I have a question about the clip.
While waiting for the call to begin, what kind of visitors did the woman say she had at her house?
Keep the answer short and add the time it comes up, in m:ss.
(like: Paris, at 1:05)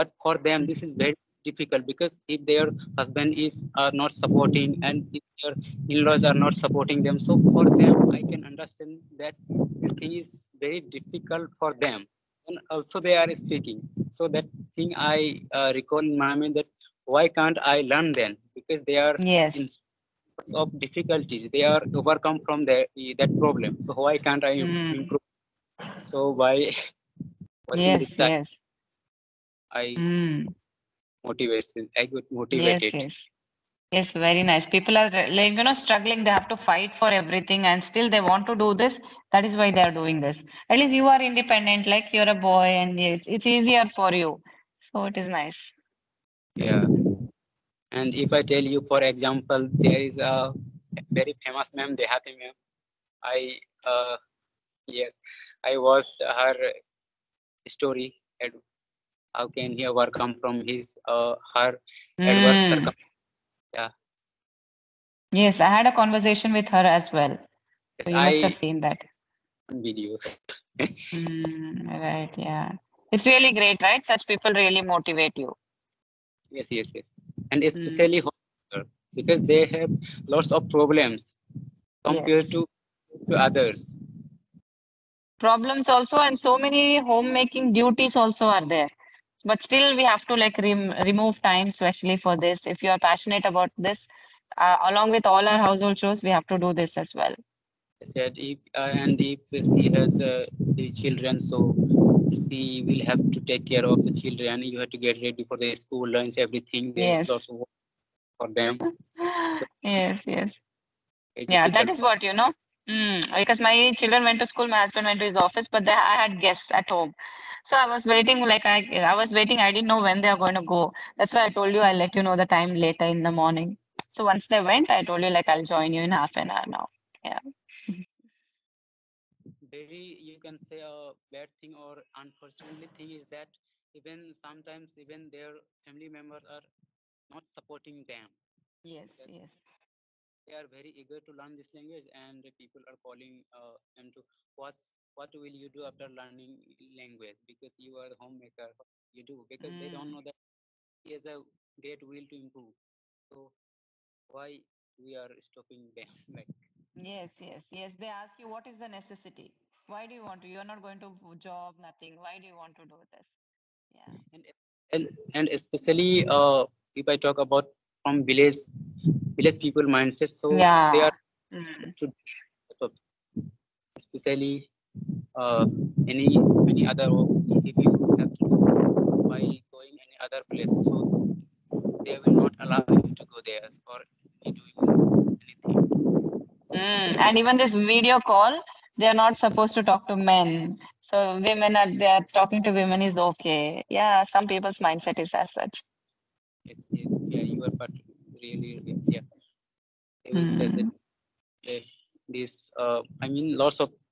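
Guests, at 1:56.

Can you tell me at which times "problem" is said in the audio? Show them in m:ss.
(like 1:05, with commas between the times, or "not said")
0:23, 1:20, 1:25.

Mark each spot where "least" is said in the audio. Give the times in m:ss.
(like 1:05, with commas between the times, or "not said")
0:40.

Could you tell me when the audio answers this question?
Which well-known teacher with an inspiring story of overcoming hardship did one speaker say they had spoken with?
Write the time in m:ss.
0:51.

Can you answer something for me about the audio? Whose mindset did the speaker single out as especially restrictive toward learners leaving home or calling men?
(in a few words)
Village people.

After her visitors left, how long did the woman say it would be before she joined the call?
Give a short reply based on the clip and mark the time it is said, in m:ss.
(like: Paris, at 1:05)
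Half an hour, at 2:06.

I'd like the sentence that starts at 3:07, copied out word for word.
And even this video call, they're not supposed to talk to men.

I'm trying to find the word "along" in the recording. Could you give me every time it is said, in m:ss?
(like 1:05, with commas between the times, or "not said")
1:34.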